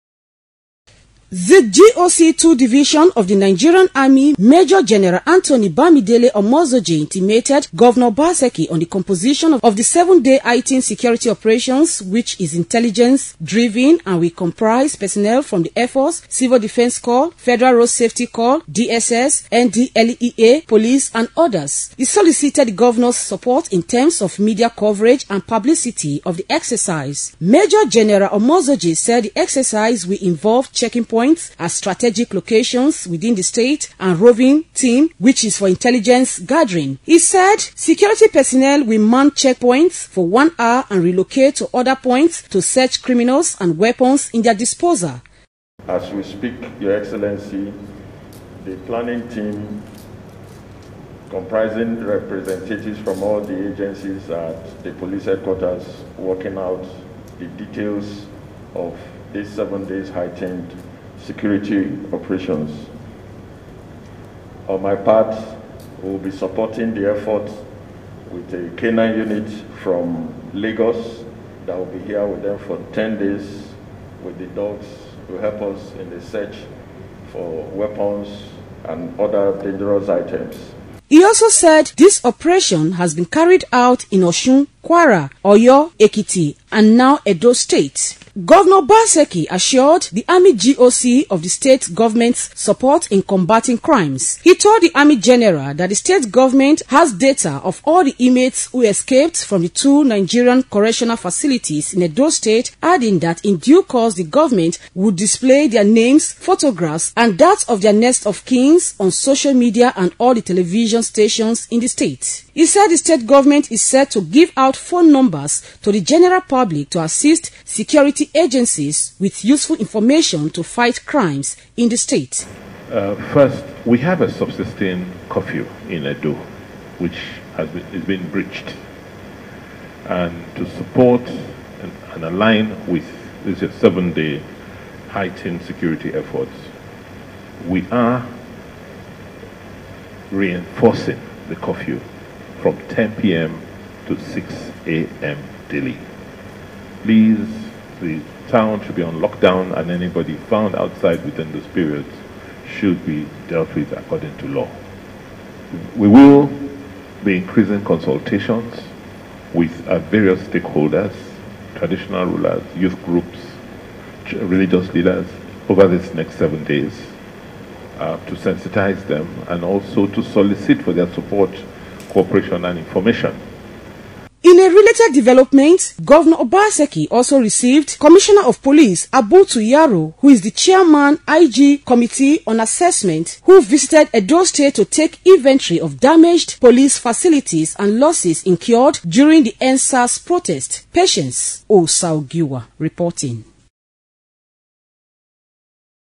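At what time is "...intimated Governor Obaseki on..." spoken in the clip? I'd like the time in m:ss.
0:06.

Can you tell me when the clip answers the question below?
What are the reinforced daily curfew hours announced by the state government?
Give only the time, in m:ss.
2:22.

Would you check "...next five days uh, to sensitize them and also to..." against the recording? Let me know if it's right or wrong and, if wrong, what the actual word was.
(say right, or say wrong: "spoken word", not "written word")
wrong: "seven", not "five".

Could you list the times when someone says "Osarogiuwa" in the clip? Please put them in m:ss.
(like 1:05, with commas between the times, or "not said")
3:11.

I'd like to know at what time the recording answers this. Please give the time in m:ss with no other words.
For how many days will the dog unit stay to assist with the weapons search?
1:12.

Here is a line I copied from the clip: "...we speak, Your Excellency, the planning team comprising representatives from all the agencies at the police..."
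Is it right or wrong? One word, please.
right.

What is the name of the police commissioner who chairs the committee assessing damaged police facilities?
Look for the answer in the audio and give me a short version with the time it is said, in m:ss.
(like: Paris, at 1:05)
Abu Yaro, at 2:59.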